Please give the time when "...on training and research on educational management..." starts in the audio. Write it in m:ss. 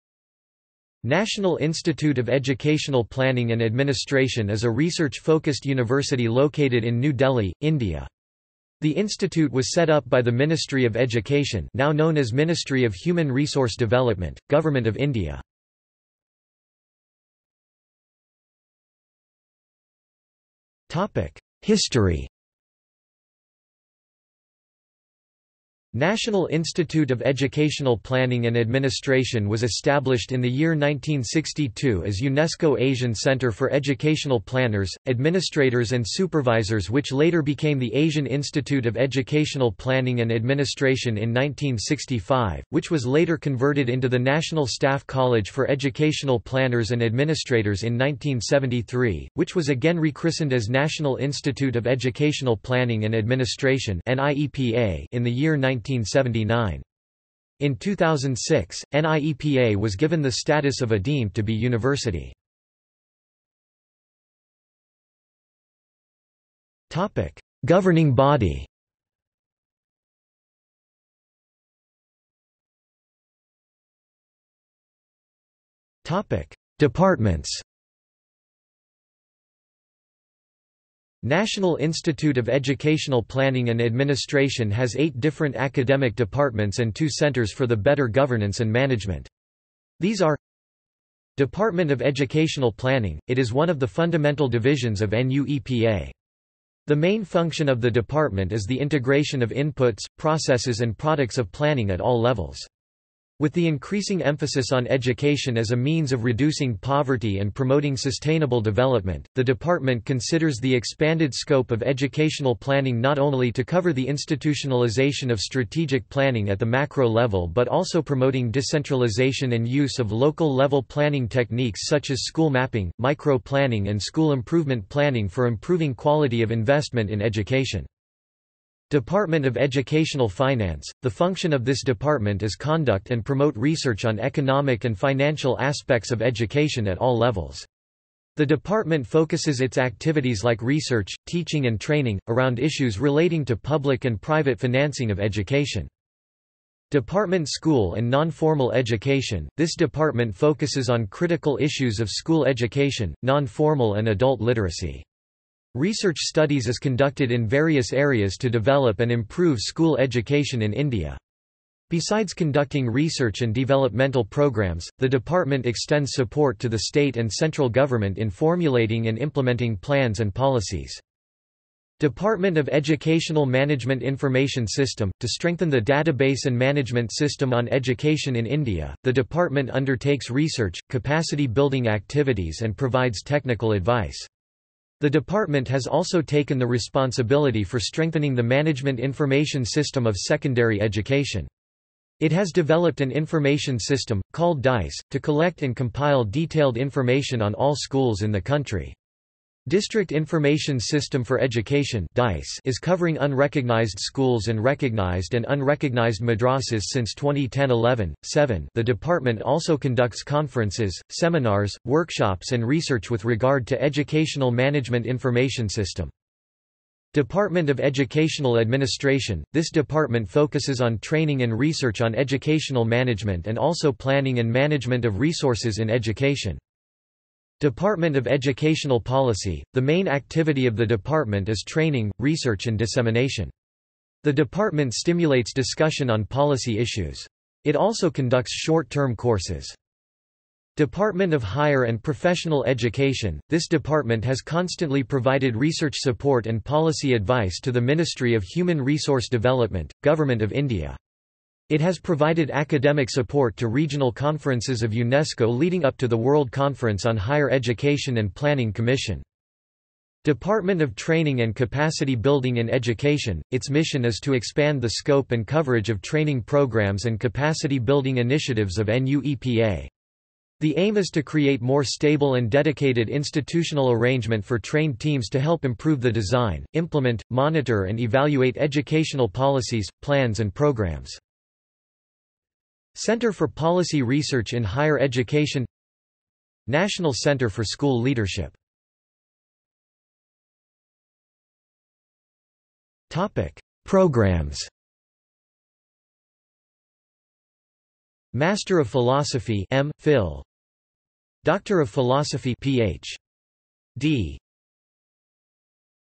3:40.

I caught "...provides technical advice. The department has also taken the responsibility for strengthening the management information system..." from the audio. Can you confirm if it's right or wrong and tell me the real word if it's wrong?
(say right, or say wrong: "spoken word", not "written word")
right.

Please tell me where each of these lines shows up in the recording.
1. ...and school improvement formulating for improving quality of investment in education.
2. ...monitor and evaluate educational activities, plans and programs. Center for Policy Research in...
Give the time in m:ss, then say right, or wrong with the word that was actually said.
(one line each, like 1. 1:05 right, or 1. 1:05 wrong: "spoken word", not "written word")
1. 2:03 wrong: "planning", not "formulating"
2. 4:37 wrong: "policies", not "activities".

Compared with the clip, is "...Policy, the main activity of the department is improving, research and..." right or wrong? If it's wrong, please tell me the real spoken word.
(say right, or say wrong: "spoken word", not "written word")
wrong: "training", not "improving".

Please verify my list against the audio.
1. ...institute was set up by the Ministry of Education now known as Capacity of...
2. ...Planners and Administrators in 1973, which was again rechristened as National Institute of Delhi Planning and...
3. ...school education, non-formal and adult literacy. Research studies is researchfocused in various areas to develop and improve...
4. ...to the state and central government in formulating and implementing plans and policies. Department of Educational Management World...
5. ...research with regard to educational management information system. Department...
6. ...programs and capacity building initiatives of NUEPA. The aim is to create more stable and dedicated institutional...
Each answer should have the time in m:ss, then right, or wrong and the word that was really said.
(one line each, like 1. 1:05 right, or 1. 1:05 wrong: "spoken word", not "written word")
1. 0:08 wrong: "Ministry", not "Capacity"
2. 0:46 wrong: "Educational", not "Delhi"
3. 2:32 wrong: "conducted", not "researchfocused"
4. 2:46 wrong: "Information", not "World"
5. 3:32 right
6. 4:26 right.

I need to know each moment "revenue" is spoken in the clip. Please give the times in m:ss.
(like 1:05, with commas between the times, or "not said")
not said.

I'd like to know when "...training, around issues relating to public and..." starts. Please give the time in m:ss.
2:21.